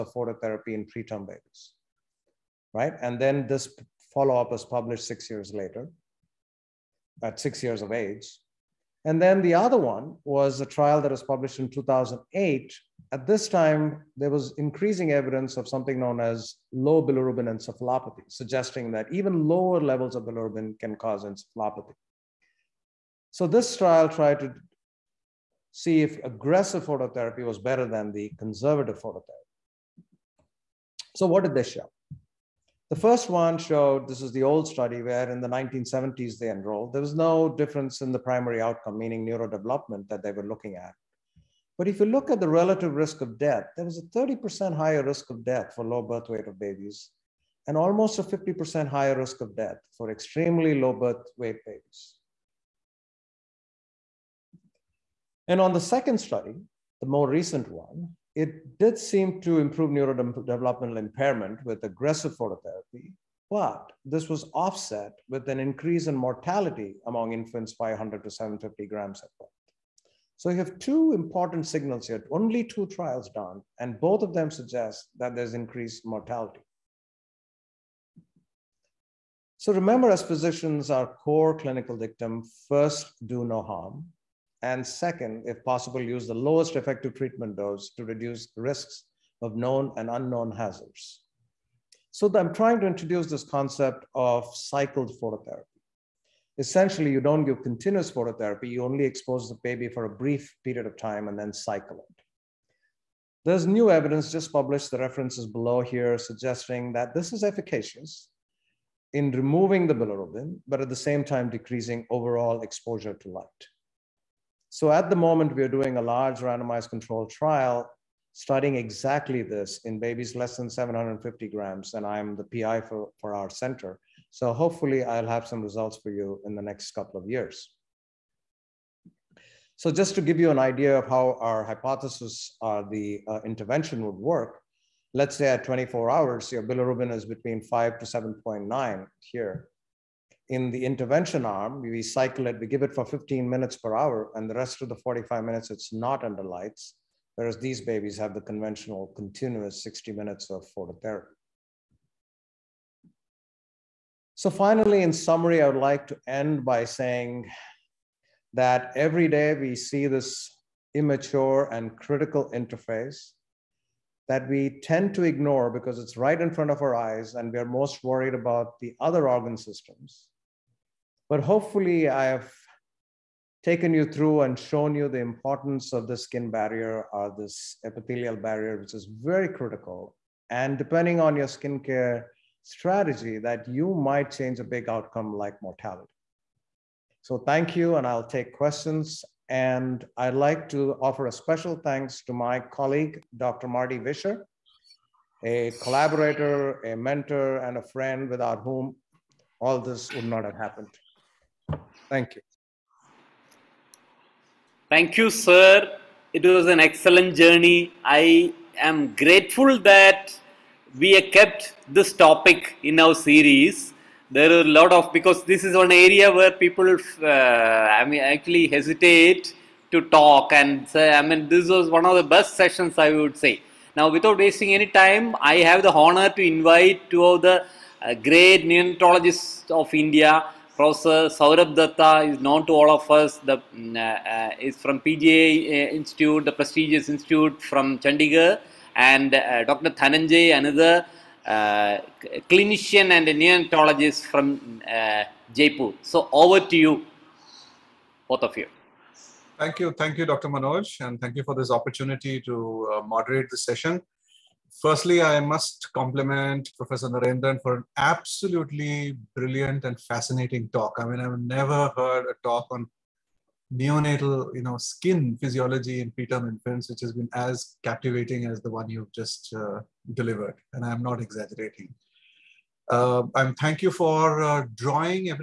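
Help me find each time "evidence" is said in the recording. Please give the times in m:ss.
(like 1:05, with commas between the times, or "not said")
0:15, 1:43.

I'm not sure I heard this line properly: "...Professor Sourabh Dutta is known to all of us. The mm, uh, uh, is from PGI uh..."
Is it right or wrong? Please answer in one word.
right.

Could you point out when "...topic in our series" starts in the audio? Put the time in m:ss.
3:32.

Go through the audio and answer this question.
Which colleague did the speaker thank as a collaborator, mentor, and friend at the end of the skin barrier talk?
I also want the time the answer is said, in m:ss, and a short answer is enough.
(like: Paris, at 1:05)
Marty Visscher, at 3:13.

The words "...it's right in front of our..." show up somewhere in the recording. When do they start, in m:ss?
2:45.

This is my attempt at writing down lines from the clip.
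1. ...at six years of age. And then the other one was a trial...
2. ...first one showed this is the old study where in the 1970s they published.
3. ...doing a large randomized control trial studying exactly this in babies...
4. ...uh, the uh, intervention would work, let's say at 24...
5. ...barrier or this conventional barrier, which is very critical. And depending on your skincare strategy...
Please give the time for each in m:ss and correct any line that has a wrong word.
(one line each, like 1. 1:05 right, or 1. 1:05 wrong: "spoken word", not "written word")
1. 0:07 right
2. 0:32 wrong: "enrolled", not "published"
3. 1:55 right
4. 2:12 right
5. 2:56 wrong: "epithelial", not "conventional".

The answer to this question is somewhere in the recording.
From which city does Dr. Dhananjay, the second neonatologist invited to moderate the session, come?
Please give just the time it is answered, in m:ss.
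4:05.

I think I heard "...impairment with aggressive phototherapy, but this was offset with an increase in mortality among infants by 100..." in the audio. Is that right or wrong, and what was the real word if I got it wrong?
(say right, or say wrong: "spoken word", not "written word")
right.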